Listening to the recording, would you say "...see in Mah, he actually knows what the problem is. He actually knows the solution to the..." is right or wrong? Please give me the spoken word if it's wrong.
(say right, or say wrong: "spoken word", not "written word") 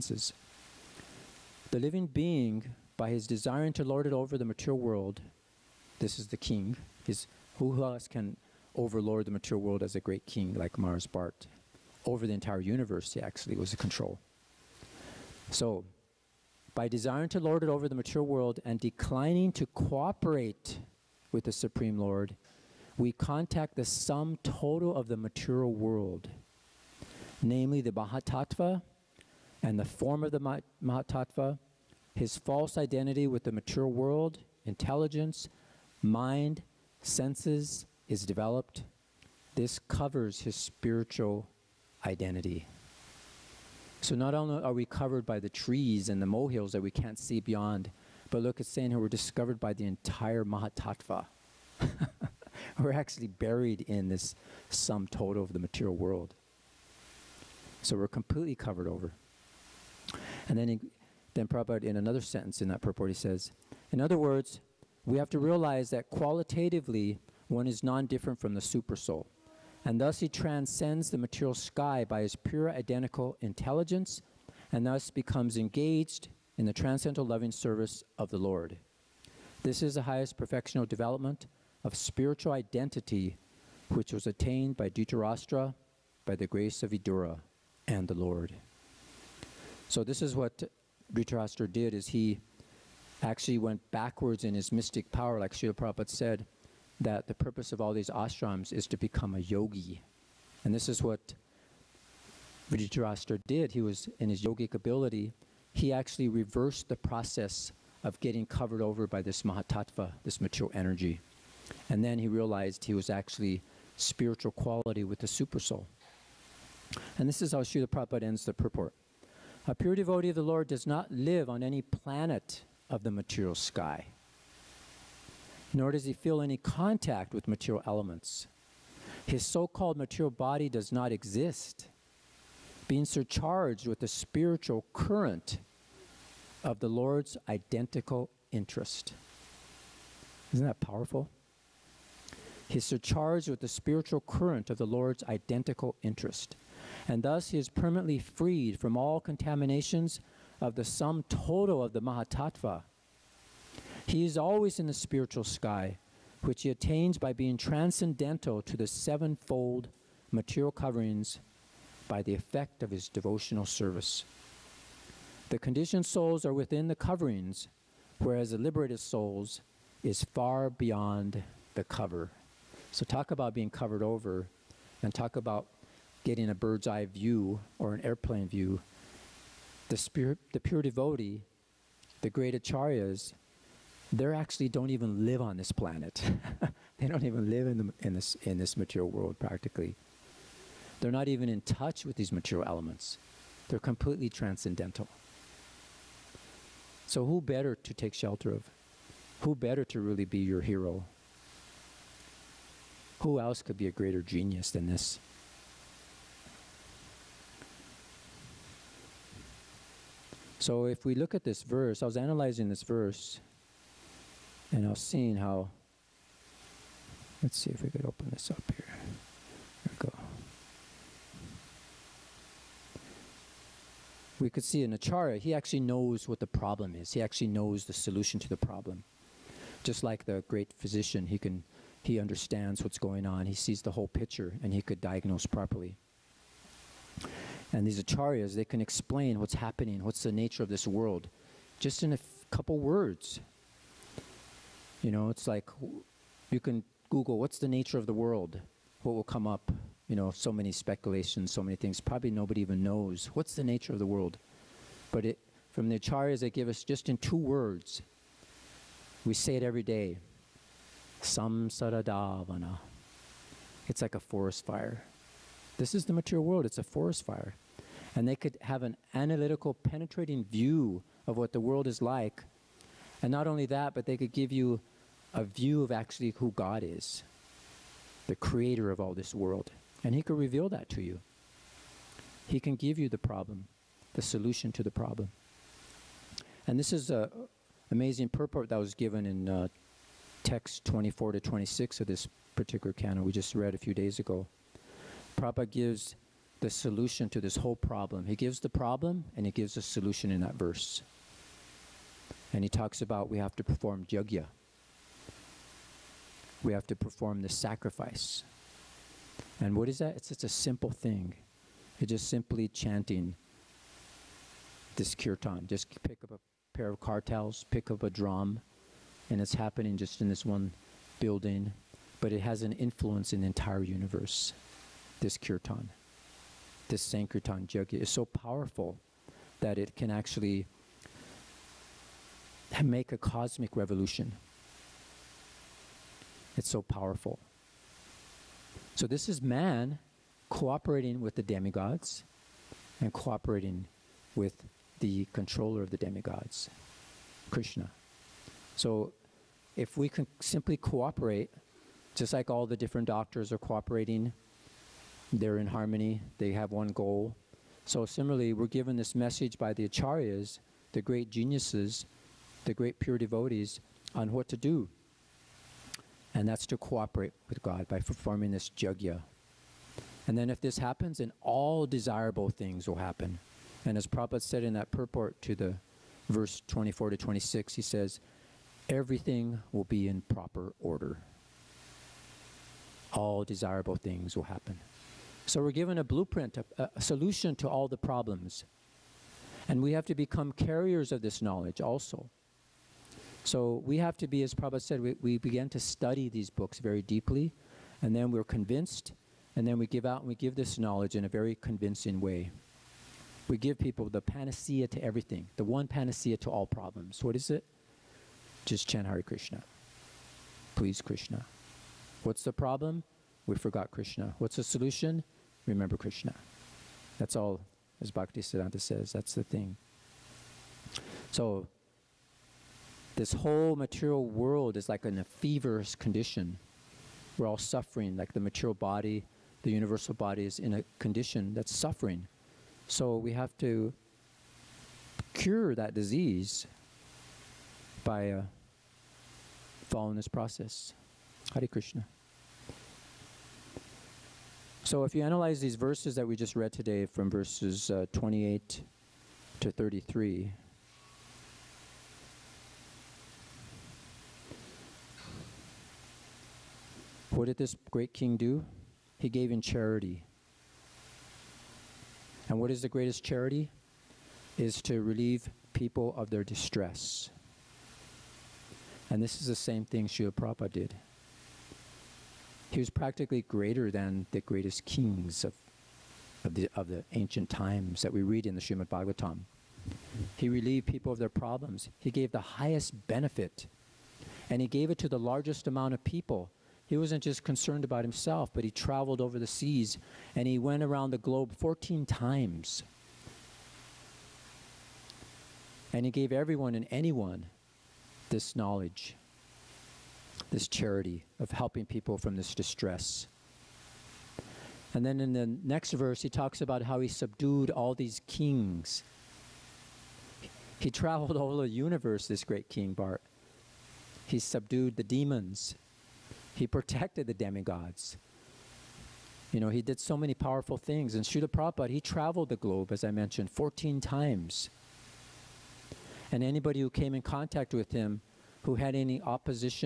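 wrong: "Acharya", not "Mah".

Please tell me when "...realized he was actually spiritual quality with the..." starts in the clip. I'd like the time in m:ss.
1:52.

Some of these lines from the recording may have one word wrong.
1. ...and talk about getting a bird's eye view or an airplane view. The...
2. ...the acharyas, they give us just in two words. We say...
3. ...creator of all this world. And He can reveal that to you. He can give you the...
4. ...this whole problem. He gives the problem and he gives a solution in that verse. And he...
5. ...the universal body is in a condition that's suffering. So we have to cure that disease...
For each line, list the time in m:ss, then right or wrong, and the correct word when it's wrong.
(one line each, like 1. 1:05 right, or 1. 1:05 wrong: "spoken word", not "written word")
1. 2:55 right
2. 4:15 right
3. 4:38 right
4. 4:57 right
5. 7:09 right.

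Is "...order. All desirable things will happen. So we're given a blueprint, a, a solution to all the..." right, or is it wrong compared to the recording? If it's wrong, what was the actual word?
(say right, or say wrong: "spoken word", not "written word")
right.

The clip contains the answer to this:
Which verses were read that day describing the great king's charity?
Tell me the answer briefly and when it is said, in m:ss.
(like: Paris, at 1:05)
28 to 33, at 7:28.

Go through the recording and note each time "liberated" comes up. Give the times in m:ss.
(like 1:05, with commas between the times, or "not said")
2:48.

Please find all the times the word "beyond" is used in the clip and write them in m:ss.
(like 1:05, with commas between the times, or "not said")
0:47, 2:50.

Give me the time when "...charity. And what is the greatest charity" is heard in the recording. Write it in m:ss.
7:39.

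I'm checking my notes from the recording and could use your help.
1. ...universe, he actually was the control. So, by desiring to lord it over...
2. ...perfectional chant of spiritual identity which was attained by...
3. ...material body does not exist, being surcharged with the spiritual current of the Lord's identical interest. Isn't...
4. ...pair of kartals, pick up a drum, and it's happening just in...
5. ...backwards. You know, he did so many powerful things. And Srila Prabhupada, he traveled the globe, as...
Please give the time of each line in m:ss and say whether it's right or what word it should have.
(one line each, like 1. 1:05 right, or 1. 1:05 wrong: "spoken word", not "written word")
1. 0:12 right
2. 1:20 wrong: "development", not "chant"
3. 2:09 right
4. 5:16 right
5. 8:37 wrong: "demigods", not "backwards".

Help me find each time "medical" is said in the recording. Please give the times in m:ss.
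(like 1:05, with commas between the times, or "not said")
not said.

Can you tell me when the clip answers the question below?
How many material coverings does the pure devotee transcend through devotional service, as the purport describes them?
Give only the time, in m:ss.
2:38.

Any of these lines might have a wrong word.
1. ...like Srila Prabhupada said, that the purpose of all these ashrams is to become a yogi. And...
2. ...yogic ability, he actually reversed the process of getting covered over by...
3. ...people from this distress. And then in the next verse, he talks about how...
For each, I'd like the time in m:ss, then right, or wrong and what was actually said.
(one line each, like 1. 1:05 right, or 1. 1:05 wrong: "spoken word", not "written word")
1. 1:35 right
2. 1:44 right
3. 8:21 right.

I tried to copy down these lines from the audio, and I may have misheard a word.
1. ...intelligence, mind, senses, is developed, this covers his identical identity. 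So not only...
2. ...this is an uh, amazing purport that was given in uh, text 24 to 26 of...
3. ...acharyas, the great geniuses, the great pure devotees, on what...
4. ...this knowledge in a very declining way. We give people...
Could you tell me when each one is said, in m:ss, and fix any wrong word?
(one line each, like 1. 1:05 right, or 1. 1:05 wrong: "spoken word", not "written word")
1. 0:34 wrong: "spiritual", not "identical"
2. 4:46 right
3. 5:59 right
4. 6:40 wrong: "convincing", not "declining".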